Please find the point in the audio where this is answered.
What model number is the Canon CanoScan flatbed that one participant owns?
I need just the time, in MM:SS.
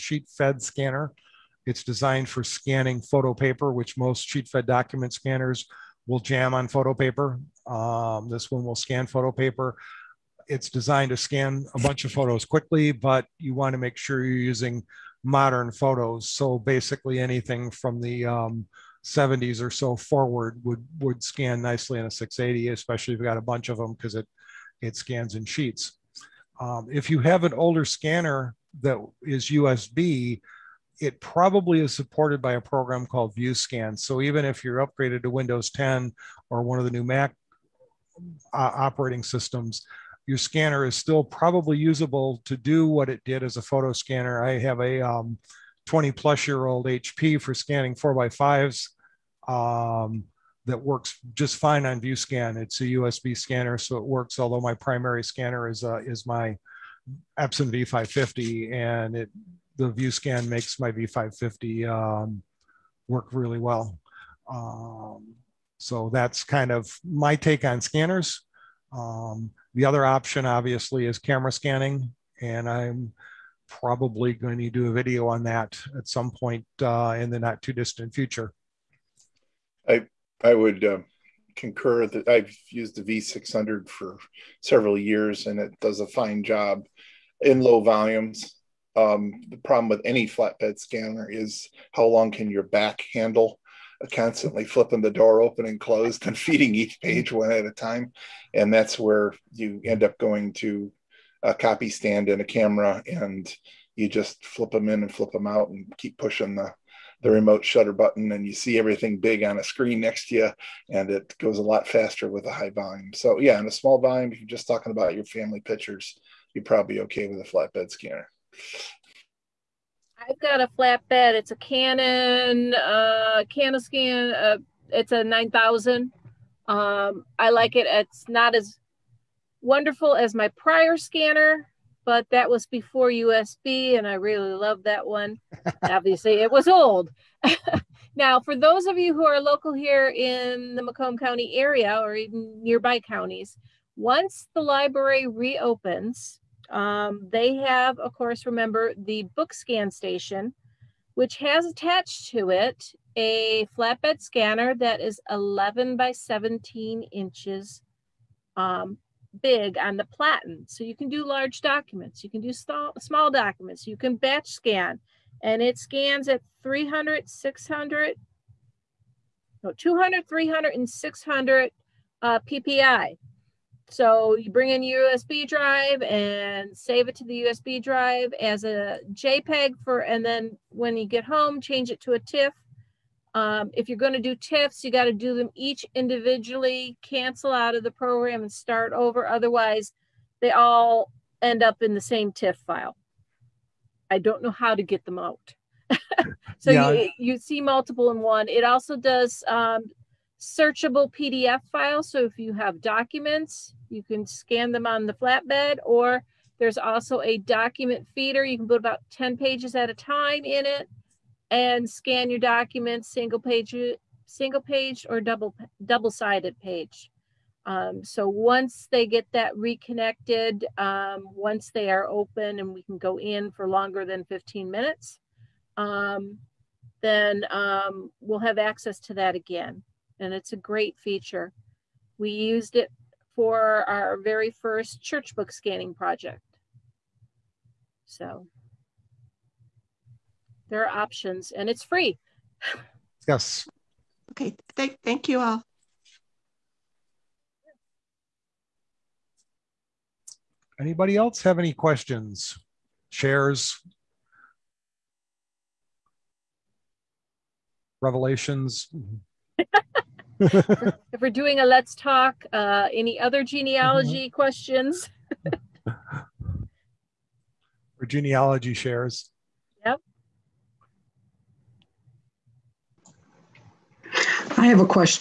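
02:05.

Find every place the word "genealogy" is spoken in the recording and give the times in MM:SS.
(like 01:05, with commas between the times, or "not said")
04:23, 04:28.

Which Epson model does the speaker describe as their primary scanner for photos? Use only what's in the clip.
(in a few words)
Epson V550.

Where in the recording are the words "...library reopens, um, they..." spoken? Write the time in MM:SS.
02:24.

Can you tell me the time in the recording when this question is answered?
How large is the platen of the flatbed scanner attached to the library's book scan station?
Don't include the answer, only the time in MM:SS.
02:35.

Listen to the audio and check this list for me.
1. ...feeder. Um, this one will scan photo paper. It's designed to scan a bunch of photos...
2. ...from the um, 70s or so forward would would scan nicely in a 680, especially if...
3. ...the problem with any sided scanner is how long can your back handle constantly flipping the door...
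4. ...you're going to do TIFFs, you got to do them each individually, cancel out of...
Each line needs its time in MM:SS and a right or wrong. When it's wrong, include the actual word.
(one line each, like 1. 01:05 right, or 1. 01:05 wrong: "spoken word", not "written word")
1. 00:06 wrong: "paper", not "feeder"
2. 00:17 right
3. 01:29 wrong: "flatbed", not "sided"
4. 03:03 right.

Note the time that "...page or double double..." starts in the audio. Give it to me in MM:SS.
03:34.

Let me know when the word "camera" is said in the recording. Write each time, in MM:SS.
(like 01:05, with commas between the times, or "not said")
01:11, 01:42.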